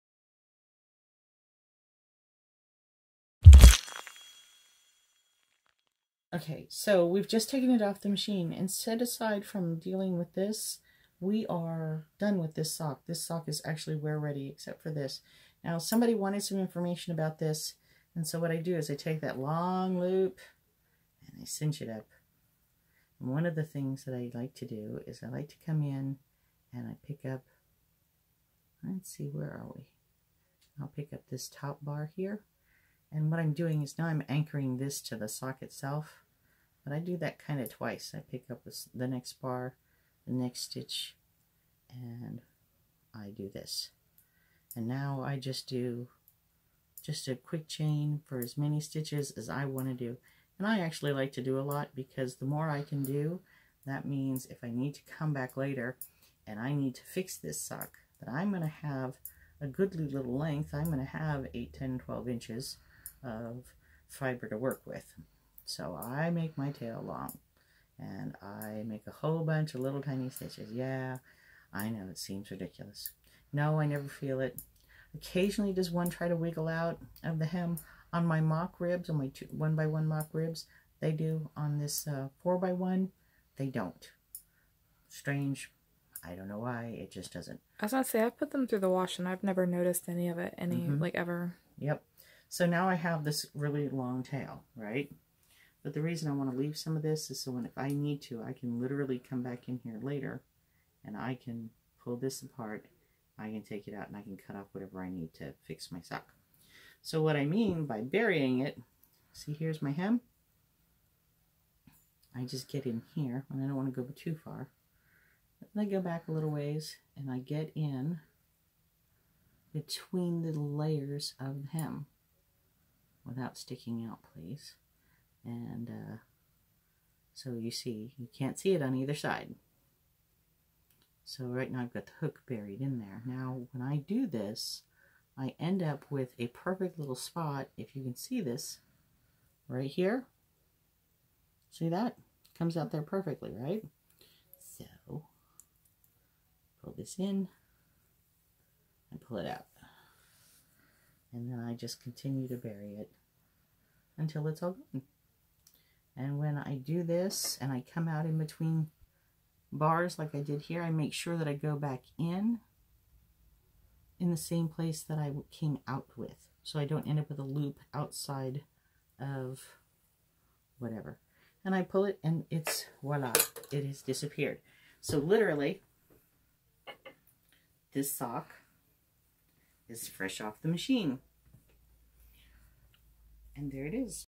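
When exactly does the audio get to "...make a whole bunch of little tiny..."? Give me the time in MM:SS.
01:08.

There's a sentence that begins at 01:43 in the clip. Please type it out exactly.
I can take it out and I can cut off whatever I need to fix my sock.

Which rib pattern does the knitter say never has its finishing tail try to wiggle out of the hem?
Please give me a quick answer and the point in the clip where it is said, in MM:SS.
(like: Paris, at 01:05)
four by one, at 01:22.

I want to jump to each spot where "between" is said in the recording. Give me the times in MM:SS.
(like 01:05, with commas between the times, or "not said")
01:59, 02:38.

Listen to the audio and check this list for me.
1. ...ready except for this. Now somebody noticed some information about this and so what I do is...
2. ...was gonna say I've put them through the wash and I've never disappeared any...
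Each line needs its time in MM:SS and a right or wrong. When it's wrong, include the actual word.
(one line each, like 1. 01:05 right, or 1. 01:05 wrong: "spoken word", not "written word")
1. 00:14 wrong: "wanted", not "noticed"
2. 01:27 wrong: "noticed", not "disappeared".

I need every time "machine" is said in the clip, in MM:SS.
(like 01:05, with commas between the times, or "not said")
00:08, 03:00.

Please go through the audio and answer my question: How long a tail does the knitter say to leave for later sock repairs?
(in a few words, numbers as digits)
8, 10, 12 inches.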